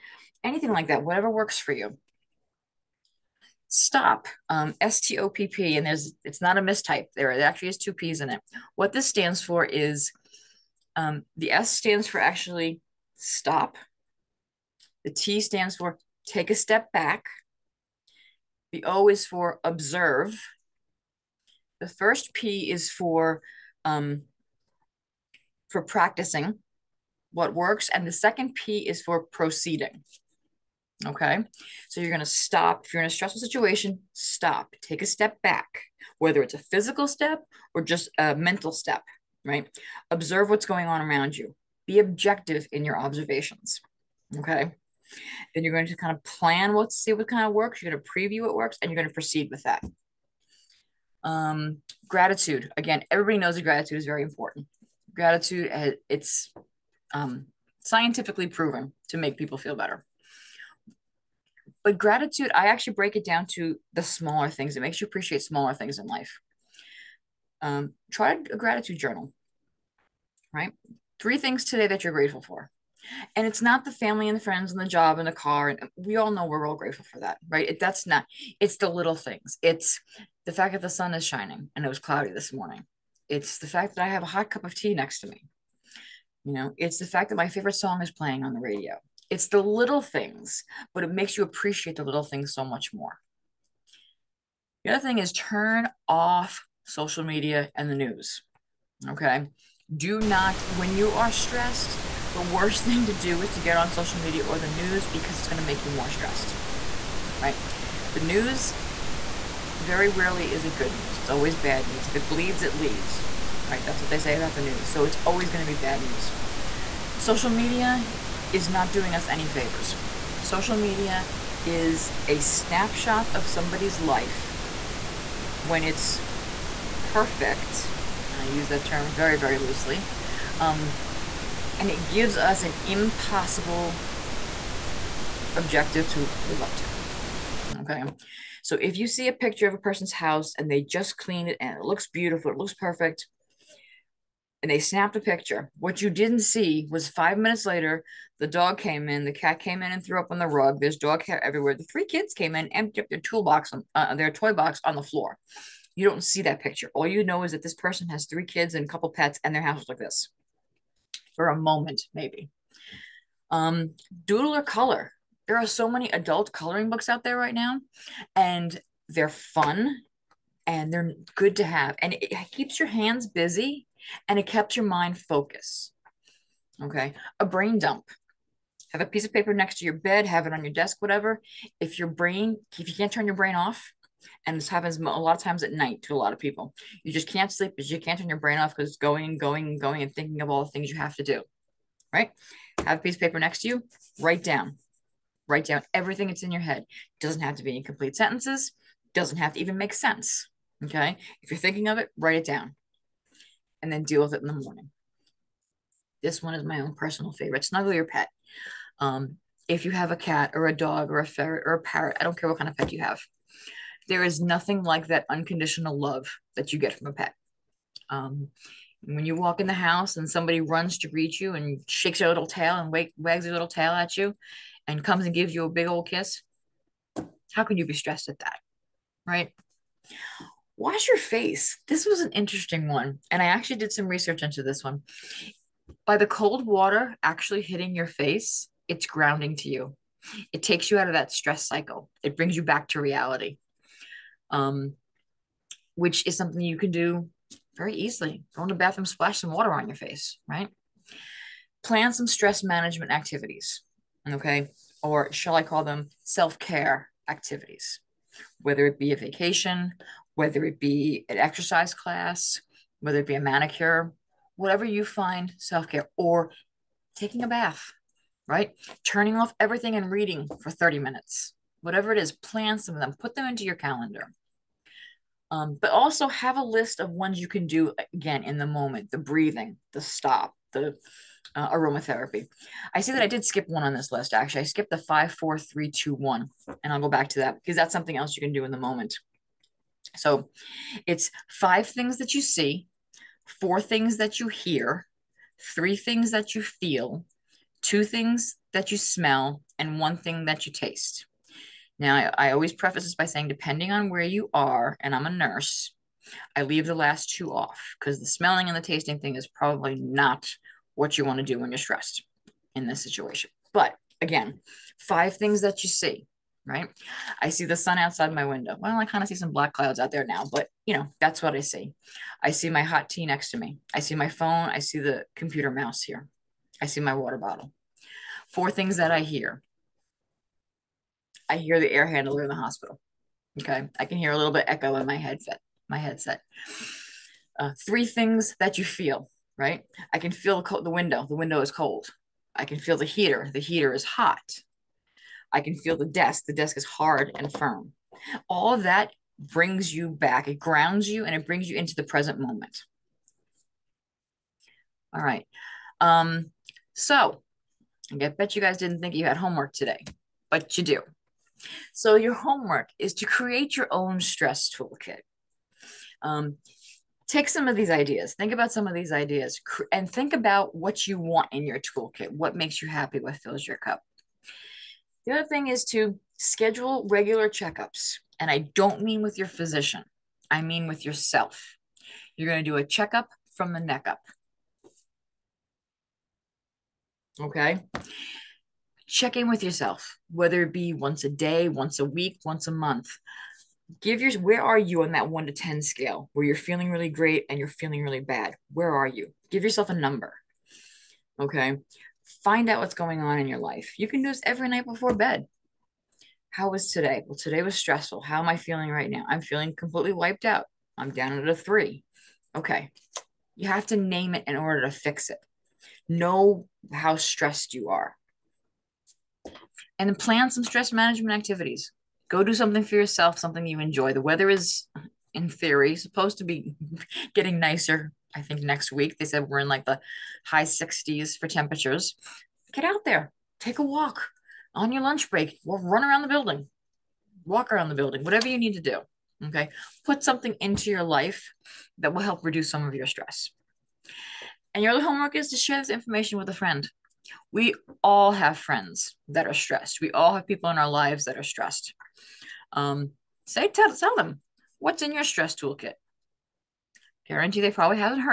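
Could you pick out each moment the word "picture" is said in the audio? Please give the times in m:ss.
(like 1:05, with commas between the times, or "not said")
2:19, 2:25, 2:36.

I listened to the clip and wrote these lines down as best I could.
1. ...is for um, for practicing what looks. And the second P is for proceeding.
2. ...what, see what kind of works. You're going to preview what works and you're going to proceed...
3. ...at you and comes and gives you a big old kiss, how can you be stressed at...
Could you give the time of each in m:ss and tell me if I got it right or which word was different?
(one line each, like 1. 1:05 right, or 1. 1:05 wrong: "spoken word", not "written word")
1. 0:22 wrong: "works", not "looks"
2. 0:46 right
3. 3:43 right.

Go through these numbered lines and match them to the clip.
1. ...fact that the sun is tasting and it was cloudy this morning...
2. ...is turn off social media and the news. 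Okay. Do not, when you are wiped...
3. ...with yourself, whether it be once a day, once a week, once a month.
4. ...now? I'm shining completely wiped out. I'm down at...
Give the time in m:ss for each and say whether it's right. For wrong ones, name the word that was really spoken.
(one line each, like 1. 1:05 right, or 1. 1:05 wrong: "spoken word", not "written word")
1. 1:20 wrong: "shining", not "tasting"
2. 1:35 wrong: "stressed", not "wiped"
3. 6:29 right
4. 6:49 wrong: "feeling", not "shining".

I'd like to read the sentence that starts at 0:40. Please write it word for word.
Observe what's going on around you.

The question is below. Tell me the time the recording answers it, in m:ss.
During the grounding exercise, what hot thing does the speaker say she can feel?
5:43.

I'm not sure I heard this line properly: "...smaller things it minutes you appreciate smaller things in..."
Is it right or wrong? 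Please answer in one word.
wrong.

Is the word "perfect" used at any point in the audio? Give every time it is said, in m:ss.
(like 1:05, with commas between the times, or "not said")
2:07, 2:22.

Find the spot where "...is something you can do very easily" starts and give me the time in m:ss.
4:06.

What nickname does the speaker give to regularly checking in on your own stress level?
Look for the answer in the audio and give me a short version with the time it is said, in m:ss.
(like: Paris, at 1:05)
A checkup from the neck up, at 6:22.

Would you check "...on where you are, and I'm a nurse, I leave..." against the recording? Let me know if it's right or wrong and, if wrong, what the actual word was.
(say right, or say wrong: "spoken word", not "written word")
right.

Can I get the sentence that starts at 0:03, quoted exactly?
Stop, um, S T O P P, and there's it's not a mistype there.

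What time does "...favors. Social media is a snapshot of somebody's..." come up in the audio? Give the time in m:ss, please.
1:59.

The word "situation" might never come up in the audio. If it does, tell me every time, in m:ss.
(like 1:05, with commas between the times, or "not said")
0:33, 5:13.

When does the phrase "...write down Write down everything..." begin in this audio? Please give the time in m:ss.
3:14.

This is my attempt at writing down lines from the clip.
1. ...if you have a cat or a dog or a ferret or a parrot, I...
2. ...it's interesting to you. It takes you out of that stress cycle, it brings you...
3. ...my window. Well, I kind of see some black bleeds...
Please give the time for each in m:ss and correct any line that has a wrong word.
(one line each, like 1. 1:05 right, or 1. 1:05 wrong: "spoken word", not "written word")
1. 3:29 right
2. 3:58 wrong: "grounding", not "interesting"
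3. 5:18 wrong: "clouds", not "bleeds".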